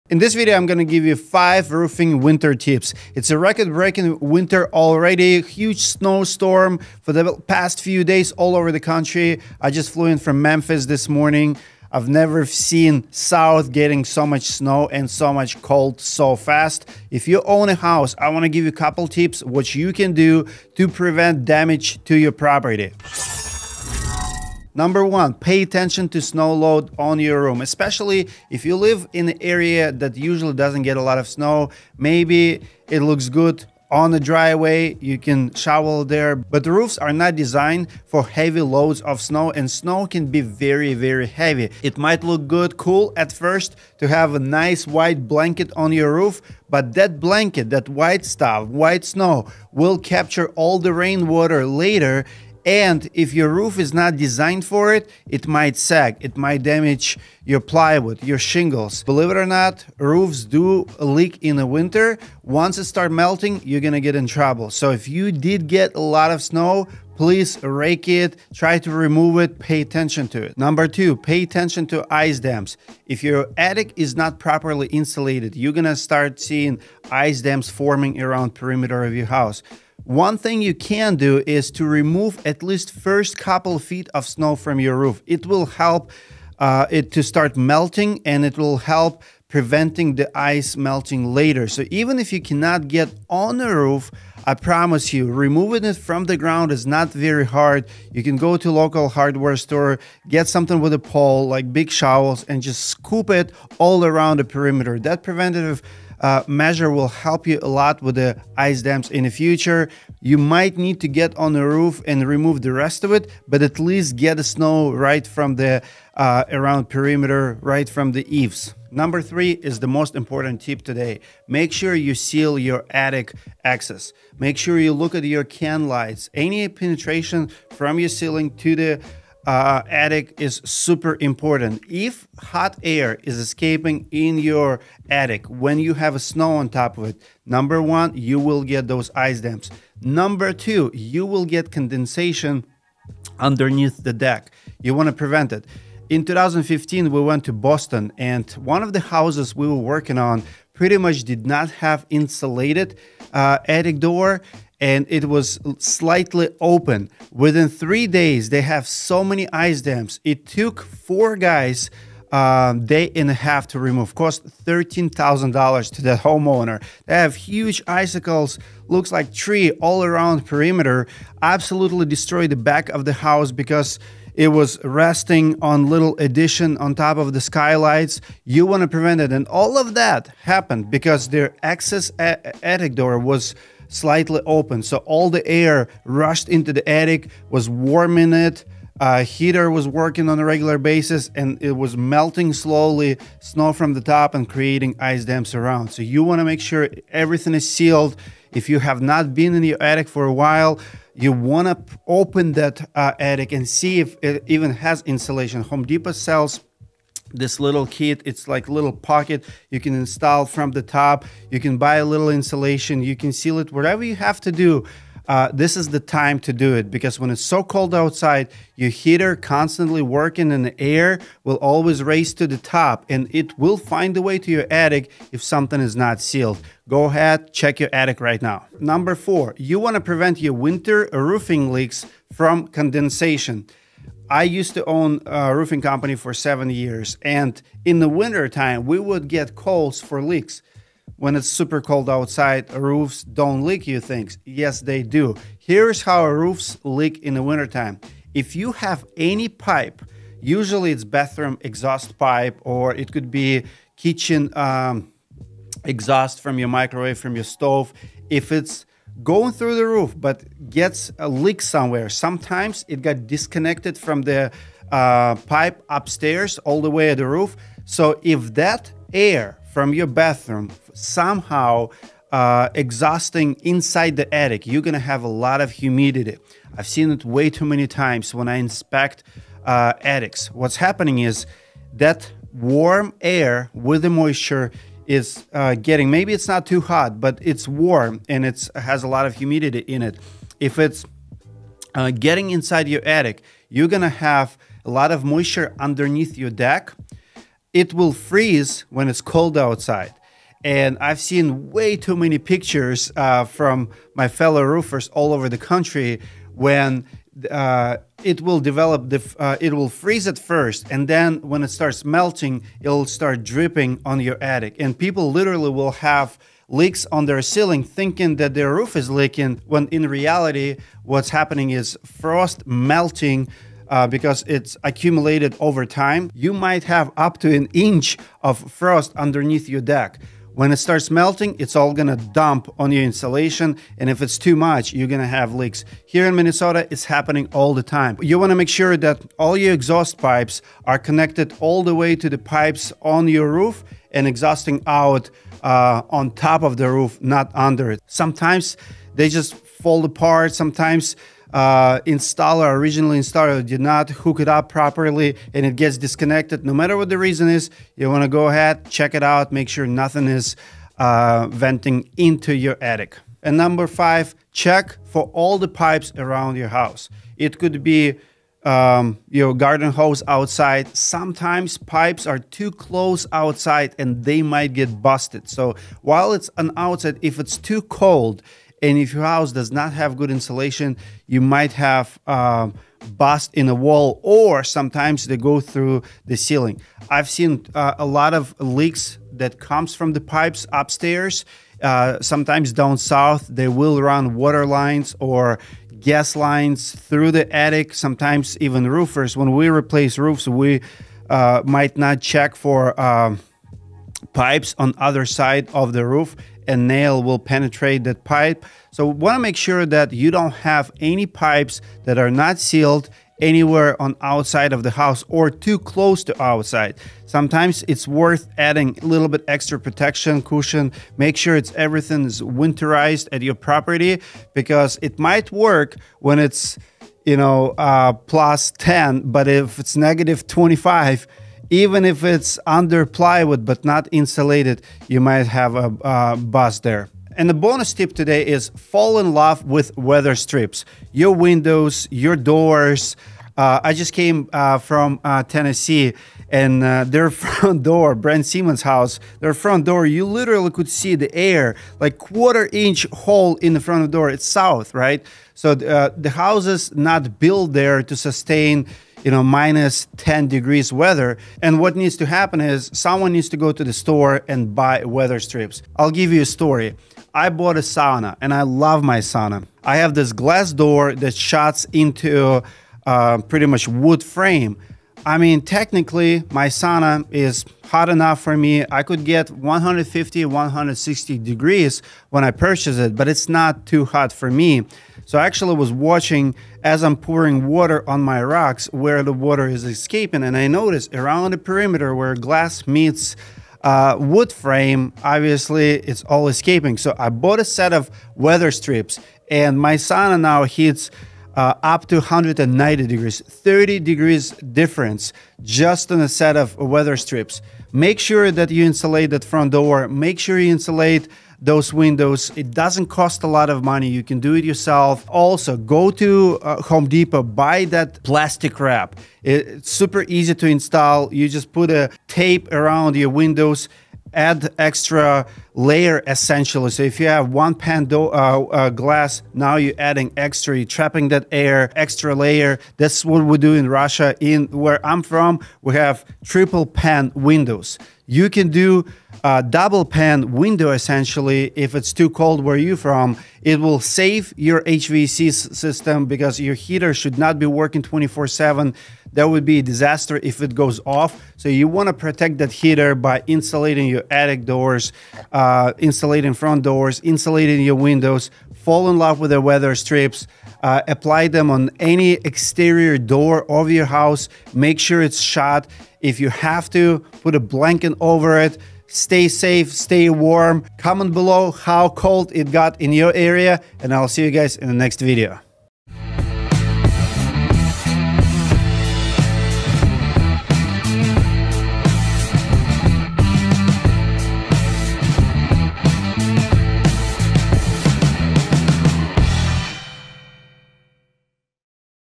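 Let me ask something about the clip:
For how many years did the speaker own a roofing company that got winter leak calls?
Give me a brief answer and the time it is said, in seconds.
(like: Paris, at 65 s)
7, at 236 s.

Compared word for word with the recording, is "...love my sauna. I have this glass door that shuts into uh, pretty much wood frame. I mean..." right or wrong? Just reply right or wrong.
right.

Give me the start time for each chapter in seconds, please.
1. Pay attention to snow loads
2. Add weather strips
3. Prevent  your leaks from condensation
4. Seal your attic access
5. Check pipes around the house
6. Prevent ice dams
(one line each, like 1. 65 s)
1. 24 s
2. 436 s
3. 228 s
4. 119 s
5. 363 s
6. 70 s.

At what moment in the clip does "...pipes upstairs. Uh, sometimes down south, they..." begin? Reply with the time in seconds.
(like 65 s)
390 s.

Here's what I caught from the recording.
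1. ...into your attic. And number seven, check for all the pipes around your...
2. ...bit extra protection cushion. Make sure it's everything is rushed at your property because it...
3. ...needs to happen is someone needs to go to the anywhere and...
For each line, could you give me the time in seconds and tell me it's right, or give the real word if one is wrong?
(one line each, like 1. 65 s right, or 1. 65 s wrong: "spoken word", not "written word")
1. 362 s wrong: "five", not "seven"
2. 419 s wrong: "winterized", not "rushed"
3. 461 s wrong: "store", not "anywhere".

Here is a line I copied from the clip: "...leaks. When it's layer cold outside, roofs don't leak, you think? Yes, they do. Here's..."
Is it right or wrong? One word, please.
wrong.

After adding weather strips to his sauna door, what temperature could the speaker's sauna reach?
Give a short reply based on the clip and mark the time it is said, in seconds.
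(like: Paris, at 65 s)
190 degrees, at 502 s.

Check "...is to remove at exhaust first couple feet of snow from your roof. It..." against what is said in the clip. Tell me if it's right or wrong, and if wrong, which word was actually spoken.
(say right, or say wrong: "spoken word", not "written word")
wrong: "least", not "exhaust".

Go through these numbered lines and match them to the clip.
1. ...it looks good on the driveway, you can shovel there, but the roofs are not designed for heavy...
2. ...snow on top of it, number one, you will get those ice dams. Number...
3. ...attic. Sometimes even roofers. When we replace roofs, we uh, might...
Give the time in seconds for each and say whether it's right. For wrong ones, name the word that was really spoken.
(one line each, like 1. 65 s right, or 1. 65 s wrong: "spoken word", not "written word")
1. 32 s right
2. 136 s right
3. 397 s right.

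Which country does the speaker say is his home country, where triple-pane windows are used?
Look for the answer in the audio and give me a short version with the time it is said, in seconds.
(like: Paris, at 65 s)
Russia, at 533 s.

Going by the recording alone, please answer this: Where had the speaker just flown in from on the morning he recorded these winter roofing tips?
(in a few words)
Memphis.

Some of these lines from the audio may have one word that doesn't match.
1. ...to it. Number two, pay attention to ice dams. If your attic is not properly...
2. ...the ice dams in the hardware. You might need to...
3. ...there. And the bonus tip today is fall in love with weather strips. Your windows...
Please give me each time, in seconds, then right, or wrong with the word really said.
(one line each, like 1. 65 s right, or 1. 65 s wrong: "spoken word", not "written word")
1. 70 s right
2. 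108 s wrong: "future", not "hardware"
3. 436 s right.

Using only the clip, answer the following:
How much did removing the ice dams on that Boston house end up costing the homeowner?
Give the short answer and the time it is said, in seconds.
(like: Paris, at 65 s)
$13,000, at 164 s.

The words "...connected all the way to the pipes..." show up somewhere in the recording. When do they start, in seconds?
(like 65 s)
340 s.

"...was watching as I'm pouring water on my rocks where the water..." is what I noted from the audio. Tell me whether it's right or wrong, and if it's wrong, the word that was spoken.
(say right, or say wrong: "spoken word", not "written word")
right.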